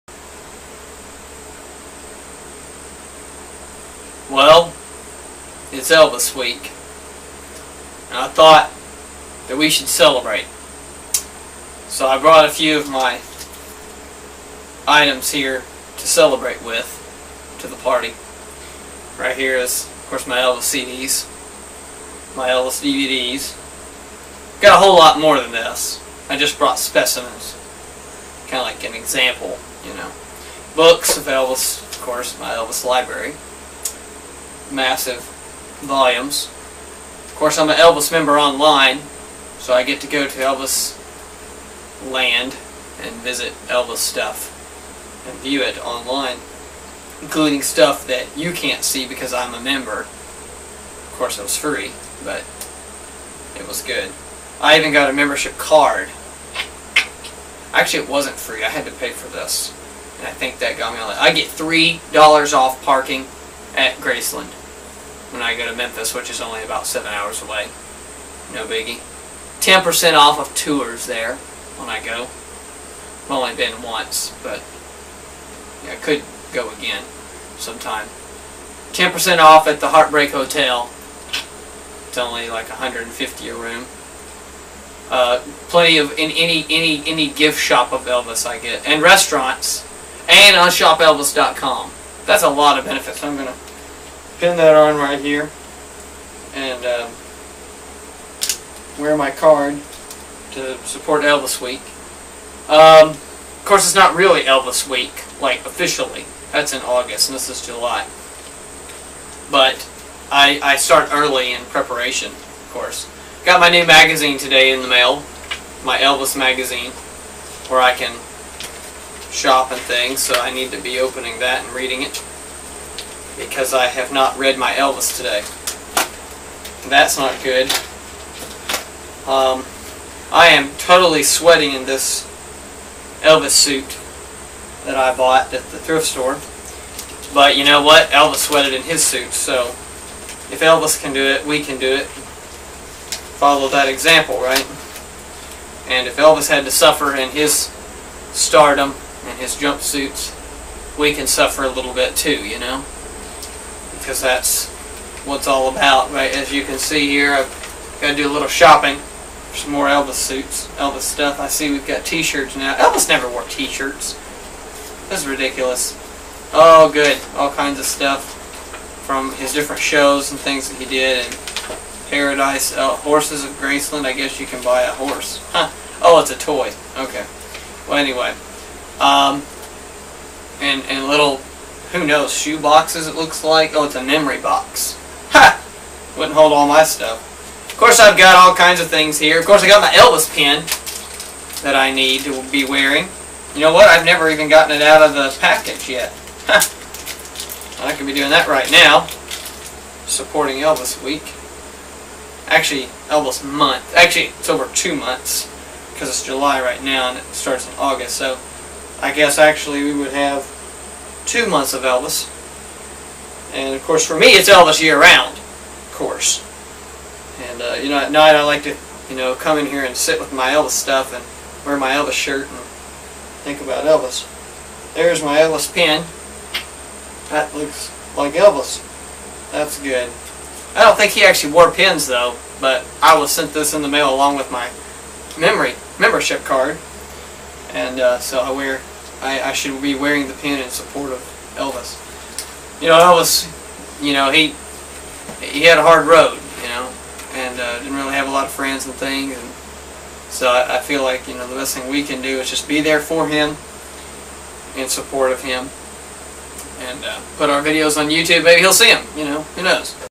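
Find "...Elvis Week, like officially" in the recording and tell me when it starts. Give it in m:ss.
1:44.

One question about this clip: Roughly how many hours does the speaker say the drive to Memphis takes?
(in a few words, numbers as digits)
7.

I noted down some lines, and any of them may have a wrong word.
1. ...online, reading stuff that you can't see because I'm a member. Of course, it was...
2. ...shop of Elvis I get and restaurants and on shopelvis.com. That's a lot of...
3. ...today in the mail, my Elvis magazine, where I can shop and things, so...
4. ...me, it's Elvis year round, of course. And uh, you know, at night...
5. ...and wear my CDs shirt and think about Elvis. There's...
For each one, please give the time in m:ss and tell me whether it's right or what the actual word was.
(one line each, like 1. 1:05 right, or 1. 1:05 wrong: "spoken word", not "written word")
1. 0:45 wrong: "including", not "reading"
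2. 1:27 right
3. 1:54 right
4. 3:34 right
5. 3:41 wrong: "Elvis", not "CDs".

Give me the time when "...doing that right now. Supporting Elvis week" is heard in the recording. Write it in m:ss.
3:18.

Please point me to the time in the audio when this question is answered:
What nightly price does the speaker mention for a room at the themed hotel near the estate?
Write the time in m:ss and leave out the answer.
1:22.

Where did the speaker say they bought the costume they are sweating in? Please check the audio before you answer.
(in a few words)
the thrift store.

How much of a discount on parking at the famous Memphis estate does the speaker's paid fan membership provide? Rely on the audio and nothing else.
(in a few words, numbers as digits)
$3.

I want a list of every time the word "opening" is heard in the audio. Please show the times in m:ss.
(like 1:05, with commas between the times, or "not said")
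2:00.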